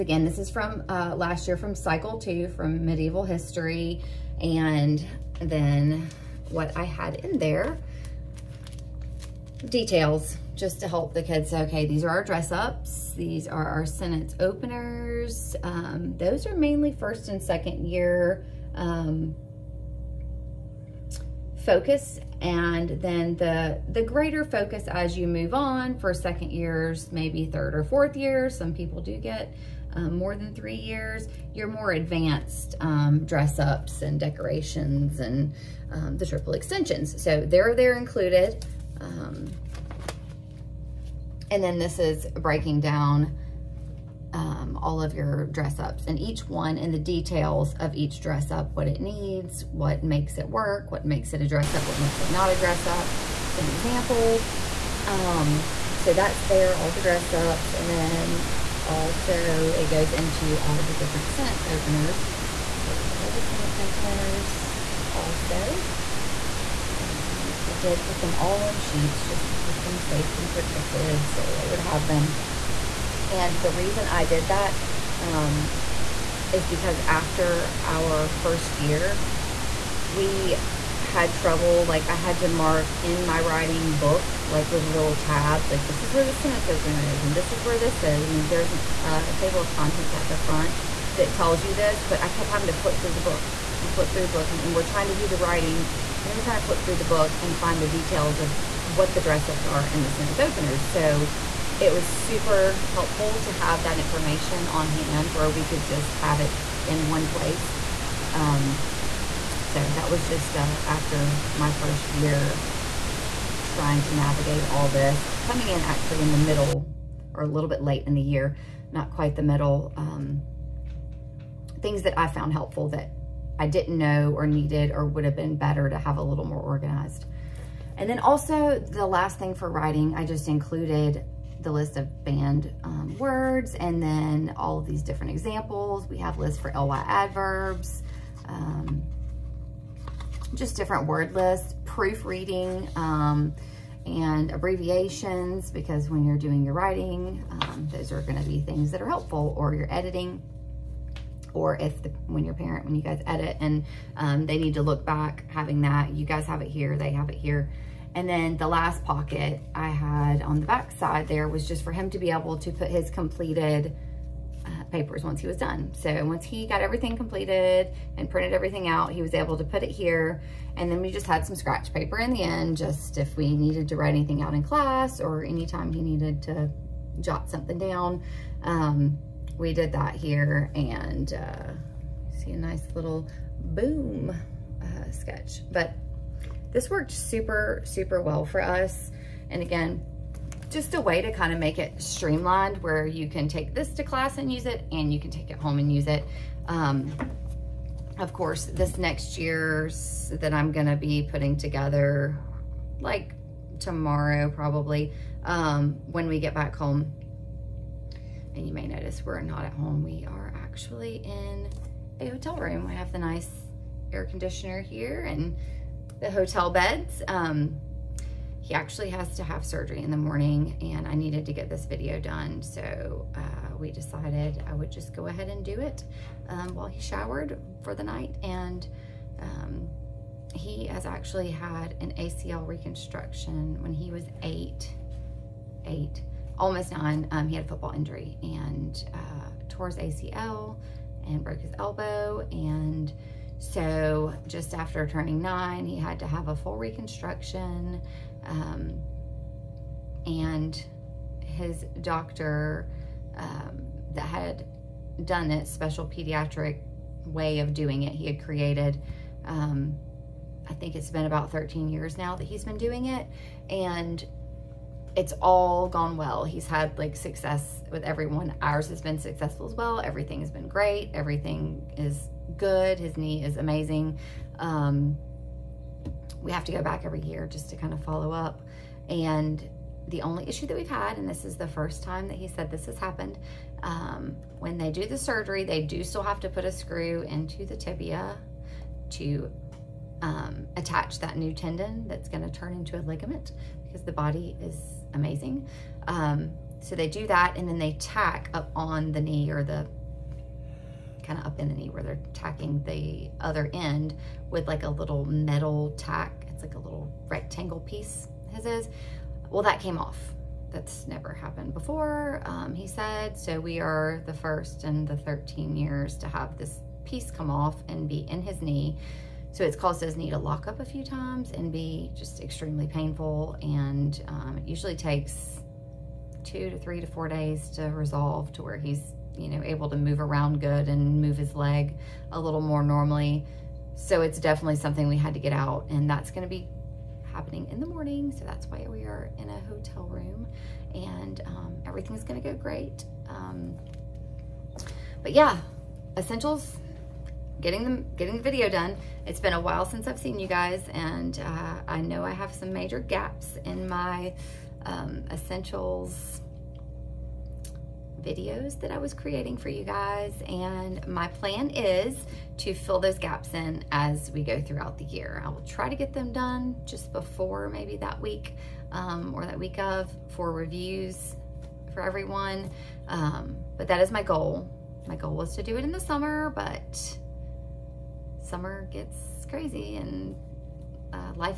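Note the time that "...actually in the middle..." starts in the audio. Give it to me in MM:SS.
01:55.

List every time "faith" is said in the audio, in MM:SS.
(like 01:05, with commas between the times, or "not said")
not said.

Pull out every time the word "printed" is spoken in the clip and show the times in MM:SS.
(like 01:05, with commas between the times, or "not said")
02:48.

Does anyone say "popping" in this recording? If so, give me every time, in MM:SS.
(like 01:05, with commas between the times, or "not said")
not said.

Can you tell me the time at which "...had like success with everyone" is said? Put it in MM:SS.
04:26.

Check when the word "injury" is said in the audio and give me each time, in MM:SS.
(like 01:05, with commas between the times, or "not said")
03:57.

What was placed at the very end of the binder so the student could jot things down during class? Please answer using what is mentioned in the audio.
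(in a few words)
scratch paper.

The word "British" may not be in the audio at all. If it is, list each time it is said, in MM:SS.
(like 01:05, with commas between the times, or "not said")
not said.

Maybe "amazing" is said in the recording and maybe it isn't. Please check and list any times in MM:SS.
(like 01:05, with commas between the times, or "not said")
04:33, 04:55.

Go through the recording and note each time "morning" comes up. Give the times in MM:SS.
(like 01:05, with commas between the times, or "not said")
03:40, 05:37.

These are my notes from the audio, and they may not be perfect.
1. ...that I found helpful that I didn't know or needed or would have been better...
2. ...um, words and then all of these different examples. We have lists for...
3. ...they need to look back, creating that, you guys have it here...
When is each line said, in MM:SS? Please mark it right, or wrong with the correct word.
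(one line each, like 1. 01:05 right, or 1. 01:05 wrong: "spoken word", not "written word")
1. 02:02 right
2. 02:12 right
3. 02:34 wrong: "having", not "creating".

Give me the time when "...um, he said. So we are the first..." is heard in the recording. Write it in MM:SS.
05:12.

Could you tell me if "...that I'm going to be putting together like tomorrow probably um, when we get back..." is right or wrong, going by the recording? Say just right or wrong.
right.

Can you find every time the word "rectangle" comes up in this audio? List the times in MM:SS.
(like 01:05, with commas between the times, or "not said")
05:07.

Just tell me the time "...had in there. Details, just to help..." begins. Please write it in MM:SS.
00:06.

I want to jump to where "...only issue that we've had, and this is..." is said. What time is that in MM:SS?
04:40.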